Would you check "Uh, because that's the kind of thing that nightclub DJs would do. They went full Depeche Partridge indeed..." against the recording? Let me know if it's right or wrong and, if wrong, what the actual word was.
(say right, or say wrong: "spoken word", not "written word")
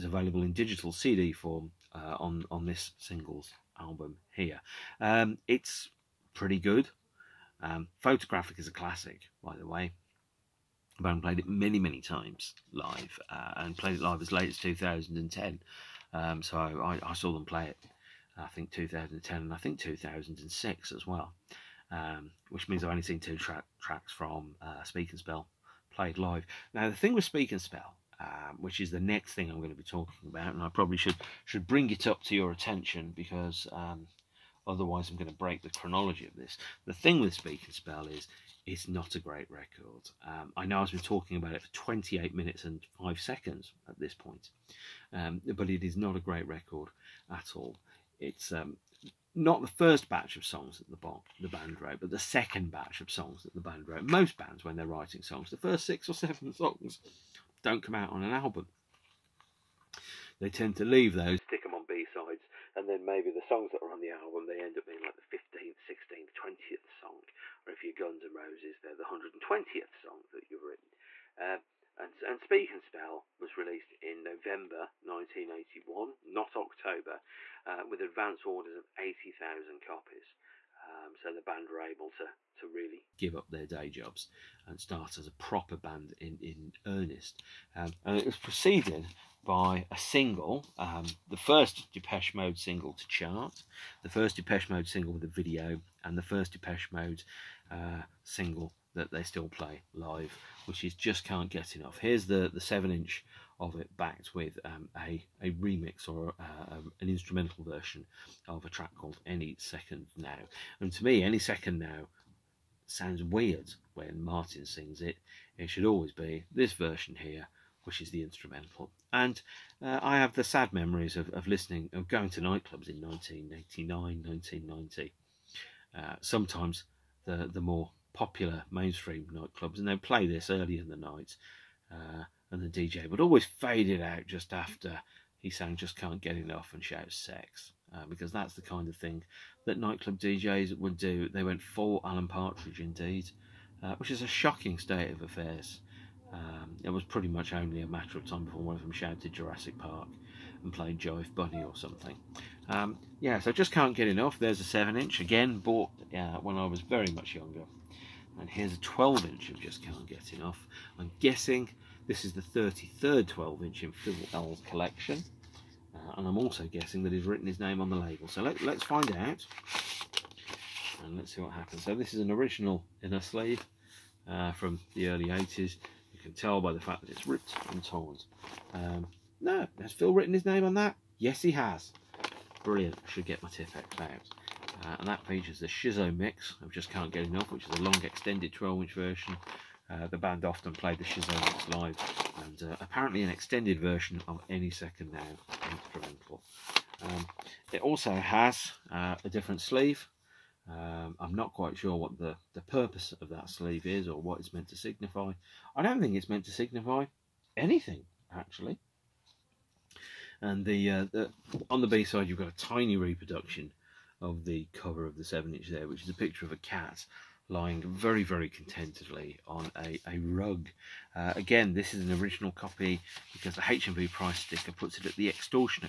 wrong: "Alan", not "Depeche".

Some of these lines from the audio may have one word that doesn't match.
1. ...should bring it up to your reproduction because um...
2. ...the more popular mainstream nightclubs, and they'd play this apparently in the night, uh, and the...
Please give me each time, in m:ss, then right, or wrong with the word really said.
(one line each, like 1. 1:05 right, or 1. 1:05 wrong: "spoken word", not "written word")
1. 0:31 wrong: "attention", not "reproduction"
2. 2:07 wrong: "early", not "apparently".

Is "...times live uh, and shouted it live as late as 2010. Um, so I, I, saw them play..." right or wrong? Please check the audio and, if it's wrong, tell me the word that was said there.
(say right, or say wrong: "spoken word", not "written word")
wrong: "played", not "shouted".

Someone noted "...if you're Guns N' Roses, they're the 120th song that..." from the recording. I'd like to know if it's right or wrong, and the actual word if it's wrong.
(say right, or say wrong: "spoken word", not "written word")
right.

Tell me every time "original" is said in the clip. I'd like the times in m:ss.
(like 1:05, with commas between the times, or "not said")
2:52, 3:42.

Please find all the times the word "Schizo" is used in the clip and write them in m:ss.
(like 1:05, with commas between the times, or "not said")
3:05, 3:11.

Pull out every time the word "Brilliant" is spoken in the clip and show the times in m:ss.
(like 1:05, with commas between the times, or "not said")
3:02.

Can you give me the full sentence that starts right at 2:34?
There's a 7 inch, again, bought uh, when I was very much younger.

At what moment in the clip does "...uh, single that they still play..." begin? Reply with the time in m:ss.
1:37.